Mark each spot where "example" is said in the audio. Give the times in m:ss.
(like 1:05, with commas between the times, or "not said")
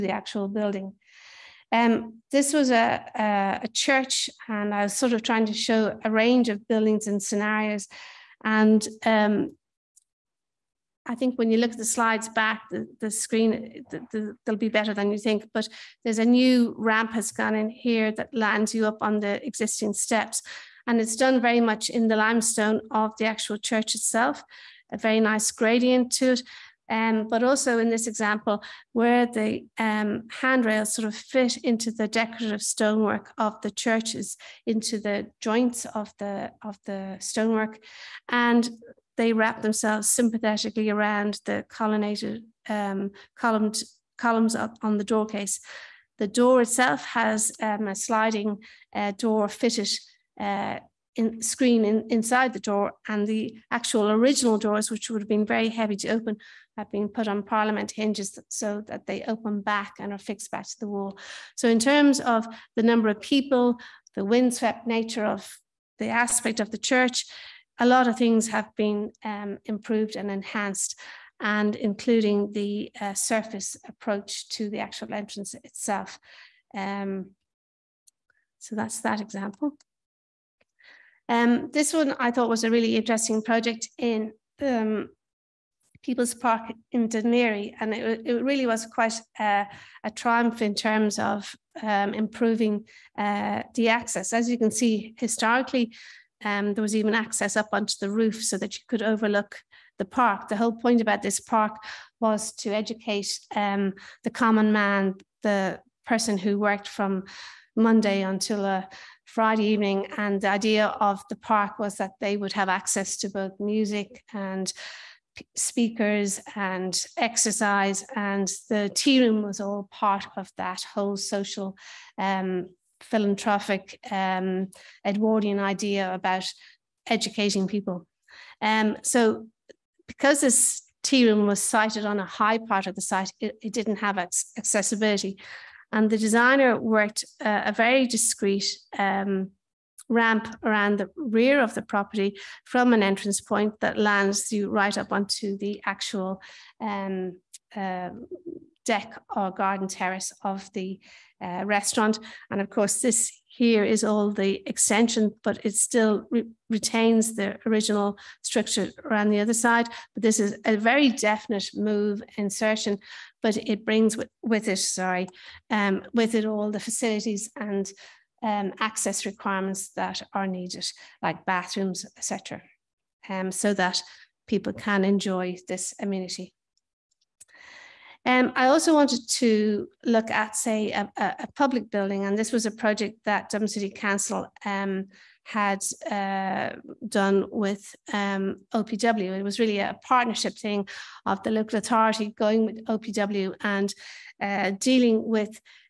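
0:28, 1:19.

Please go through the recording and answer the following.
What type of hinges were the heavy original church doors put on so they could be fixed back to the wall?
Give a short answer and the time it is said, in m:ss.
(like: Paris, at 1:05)
parliament hinges, at 0:57.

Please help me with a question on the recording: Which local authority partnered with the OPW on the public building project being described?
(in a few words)
Dublin City Council.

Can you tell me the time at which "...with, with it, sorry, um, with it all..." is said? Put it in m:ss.
2:44.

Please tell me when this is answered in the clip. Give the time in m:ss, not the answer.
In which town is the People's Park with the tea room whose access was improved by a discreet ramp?
1:27.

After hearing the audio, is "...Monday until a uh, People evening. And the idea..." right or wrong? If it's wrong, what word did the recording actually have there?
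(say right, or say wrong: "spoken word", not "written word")
wrong: "Friday", not "People".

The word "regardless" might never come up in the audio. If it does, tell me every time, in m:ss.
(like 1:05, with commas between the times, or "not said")
not said.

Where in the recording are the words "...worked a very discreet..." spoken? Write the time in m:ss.
2:16.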